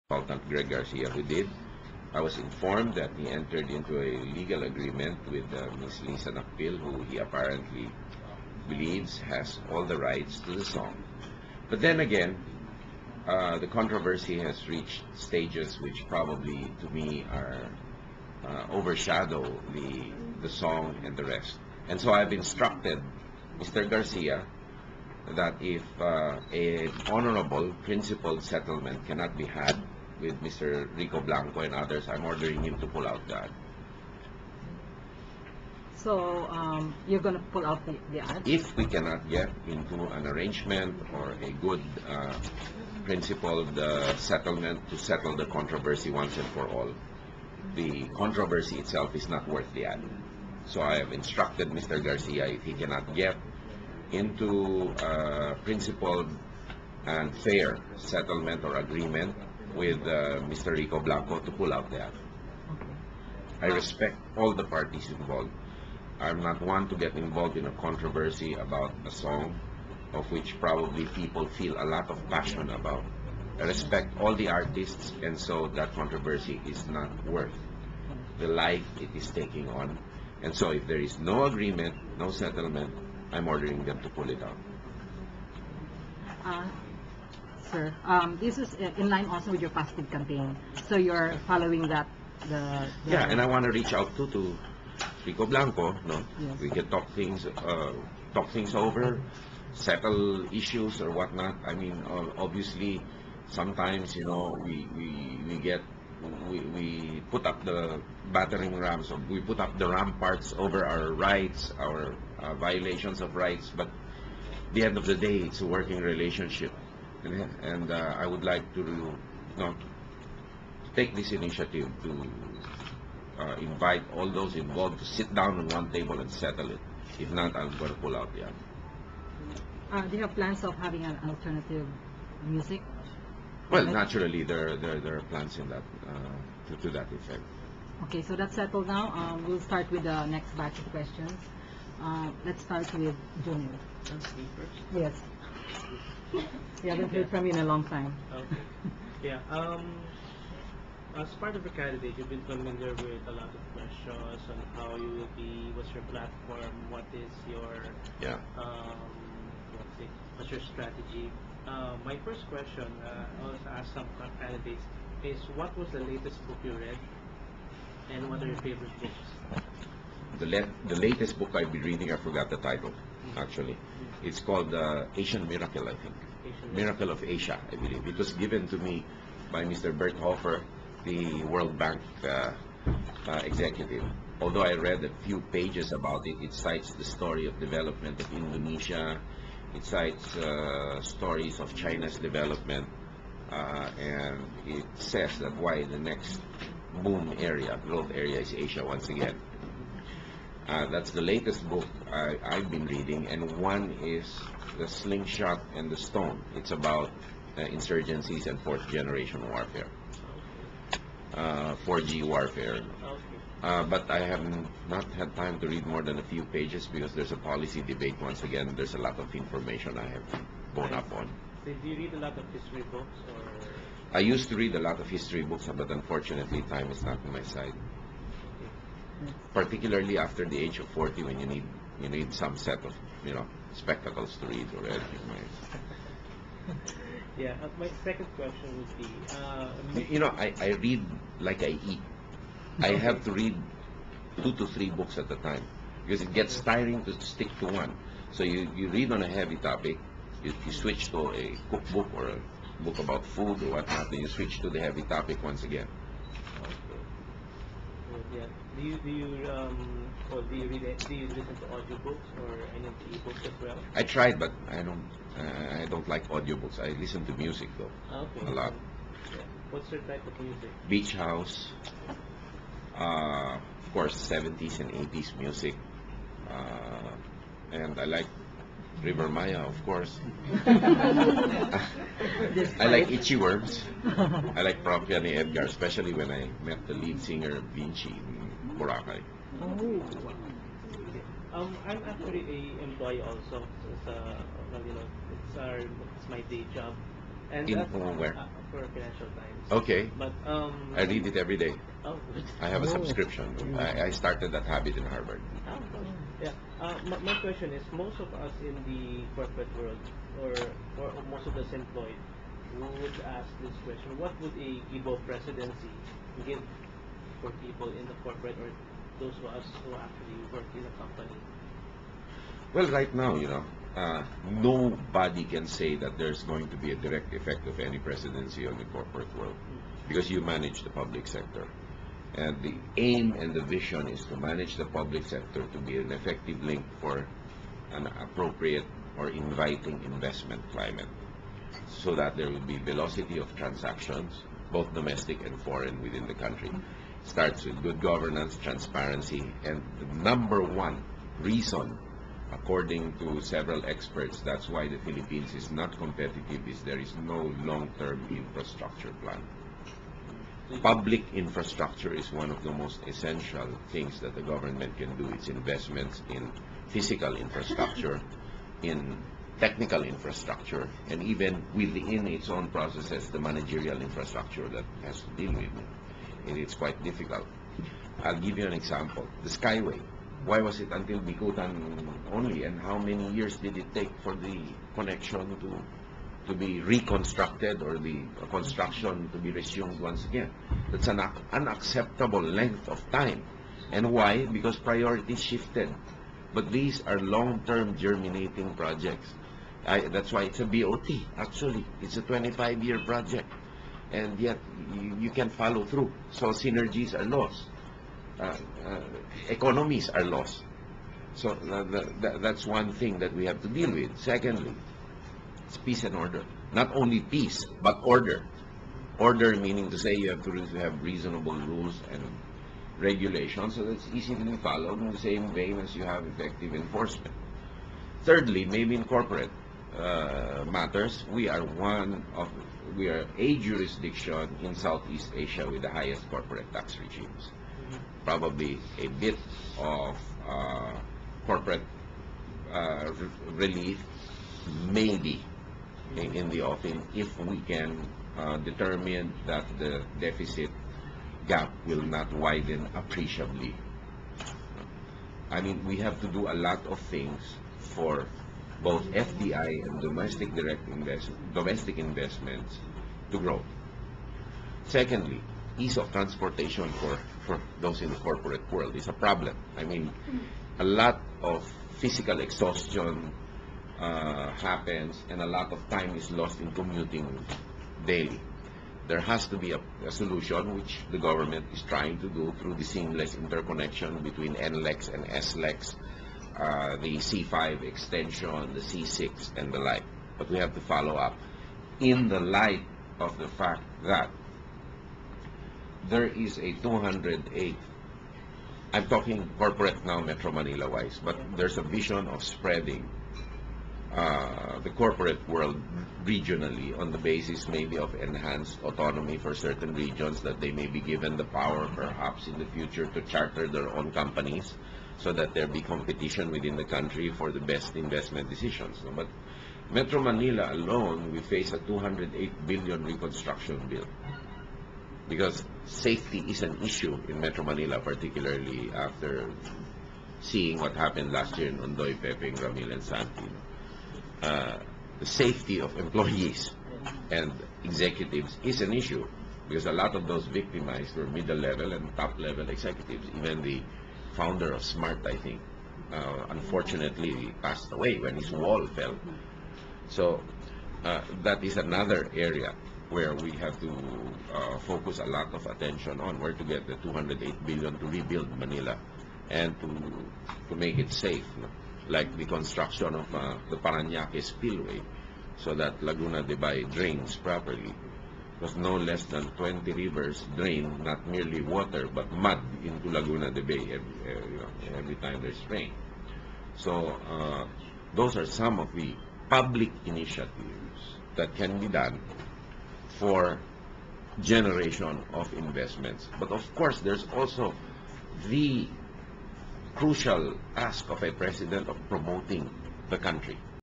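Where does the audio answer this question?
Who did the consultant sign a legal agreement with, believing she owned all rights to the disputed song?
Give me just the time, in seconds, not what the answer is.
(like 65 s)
6 s.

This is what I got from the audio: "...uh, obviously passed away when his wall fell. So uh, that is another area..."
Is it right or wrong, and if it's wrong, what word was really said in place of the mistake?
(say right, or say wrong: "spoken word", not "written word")
wrong: "unfortunately", not "obviously".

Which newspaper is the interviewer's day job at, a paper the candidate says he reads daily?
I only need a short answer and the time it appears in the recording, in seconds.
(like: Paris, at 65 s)
Financial Times, at 298 s.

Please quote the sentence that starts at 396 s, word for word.
But these are long-term germinating projects.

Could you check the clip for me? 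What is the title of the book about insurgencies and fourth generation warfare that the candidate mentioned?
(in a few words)
The Slingshot and the Stone.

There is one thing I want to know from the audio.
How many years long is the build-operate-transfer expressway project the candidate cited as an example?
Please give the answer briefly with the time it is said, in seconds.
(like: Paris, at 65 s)
25, at 402 s.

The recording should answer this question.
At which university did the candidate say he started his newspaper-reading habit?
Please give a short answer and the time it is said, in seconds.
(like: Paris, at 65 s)
Harvard, at 305 s.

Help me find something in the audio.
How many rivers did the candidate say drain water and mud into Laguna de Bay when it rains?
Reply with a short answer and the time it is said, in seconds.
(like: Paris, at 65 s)
20, at 569 s.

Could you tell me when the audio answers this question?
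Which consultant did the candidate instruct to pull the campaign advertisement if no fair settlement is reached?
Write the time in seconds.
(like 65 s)
0 s.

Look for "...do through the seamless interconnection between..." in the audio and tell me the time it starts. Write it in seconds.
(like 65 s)
482 s.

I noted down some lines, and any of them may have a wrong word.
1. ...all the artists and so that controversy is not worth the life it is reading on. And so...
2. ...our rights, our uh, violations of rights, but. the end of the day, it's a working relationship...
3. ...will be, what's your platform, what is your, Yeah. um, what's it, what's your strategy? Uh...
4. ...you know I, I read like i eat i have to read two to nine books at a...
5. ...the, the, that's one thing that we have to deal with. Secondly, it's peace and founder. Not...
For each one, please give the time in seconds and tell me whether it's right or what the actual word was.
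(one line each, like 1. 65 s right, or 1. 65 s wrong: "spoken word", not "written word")
1. 74 s wrong: "taking", not "reading"
2. 110 s right
3. 155 s right
4. 240 s wrong: "three", not "nine"
5. 411 s wrong: "order", not "founder".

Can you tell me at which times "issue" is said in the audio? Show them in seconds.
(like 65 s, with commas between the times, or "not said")
100 s, 526 s, 538 s.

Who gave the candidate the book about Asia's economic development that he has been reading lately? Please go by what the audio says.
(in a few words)
Bert Hofman.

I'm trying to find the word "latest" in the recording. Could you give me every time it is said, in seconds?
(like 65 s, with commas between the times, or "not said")
165 s, 170 s, 201 s.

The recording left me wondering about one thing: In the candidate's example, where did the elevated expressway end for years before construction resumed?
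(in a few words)
Bikutan.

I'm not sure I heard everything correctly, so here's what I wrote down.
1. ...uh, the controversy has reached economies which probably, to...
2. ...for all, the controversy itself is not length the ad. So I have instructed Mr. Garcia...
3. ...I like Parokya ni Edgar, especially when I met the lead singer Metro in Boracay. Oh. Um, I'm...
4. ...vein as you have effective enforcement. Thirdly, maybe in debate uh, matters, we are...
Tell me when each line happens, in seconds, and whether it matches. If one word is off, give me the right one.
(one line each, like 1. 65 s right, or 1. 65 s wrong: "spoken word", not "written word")
1. 13 s wrong: "stages", not "economies"
2. 46 s wrong: "worth", not "length"
3. 284 s wrong: "Vinci", not "Metro"
4. 425 s wrong: "corporate", not "debate".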